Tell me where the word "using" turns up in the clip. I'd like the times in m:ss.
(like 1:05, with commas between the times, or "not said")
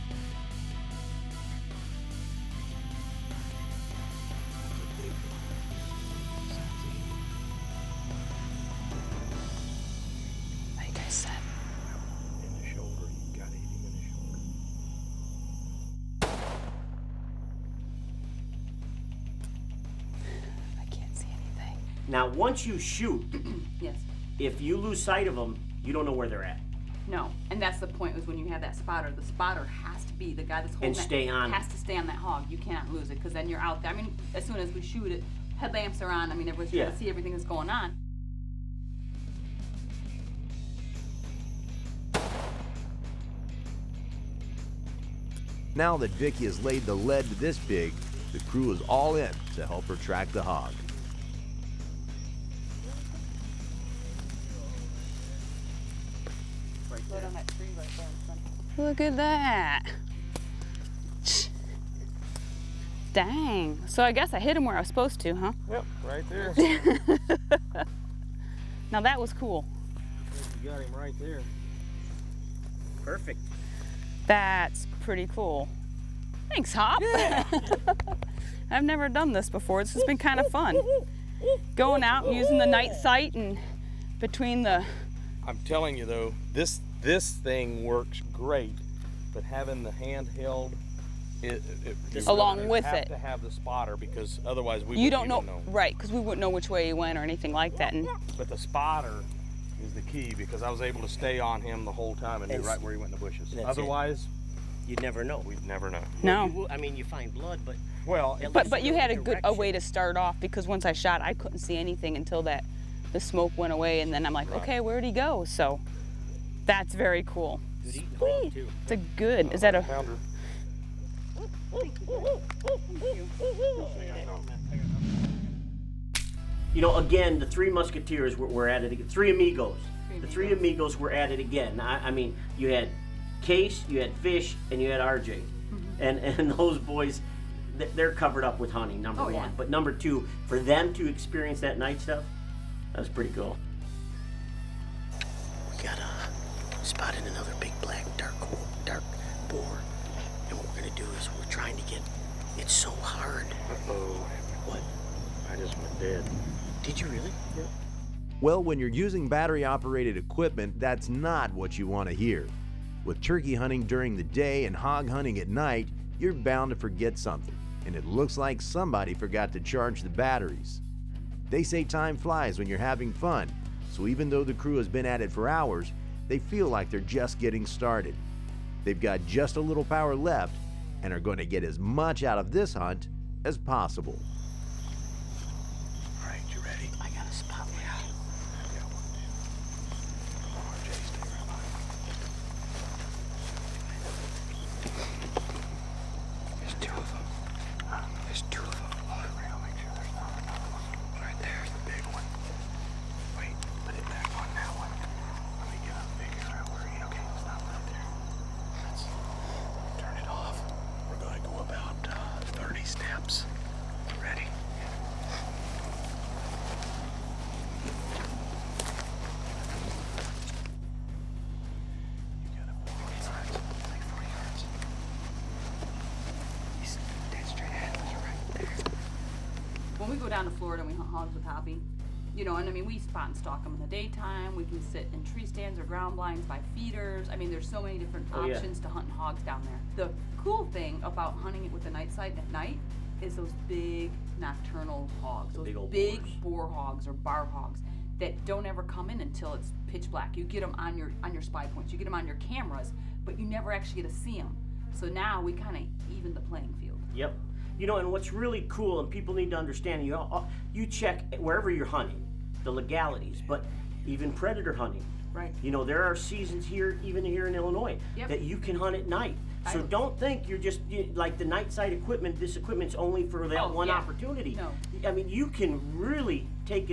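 1:22, 2:38.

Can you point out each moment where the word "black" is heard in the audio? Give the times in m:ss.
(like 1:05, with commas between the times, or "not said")
2:27, 4:10.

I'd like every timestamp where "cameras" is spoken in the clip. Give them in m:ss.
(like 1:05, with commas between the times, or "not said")
4:12.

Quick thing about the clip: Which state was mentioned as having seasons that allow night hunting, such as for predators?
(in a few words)
Illinois.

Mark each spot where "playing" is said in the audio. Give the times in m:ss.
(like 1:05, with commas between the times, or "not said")
4:16.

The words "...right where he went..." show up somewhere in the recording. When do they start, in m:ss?
1:42.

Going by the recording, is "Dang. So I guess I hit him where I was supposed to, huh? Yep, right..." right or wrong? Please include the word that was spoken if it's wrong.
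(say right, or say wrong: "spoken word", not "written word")
right.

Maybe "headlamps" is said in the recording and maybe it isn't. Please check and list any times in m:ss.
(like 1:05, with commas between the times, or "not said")
0:35.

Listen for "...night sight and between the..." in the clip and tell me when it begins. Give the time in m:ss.
1:22.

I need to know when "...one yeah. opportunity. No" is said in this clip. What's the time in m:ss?
4:33.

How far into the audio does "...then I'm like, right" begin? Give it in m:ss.
1:54.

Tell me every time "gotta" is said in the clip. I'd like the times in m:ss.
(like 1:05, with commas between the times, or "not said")
not said.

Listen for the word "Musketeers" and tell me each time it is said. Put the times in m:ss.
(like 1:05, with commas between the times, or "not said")
2:07.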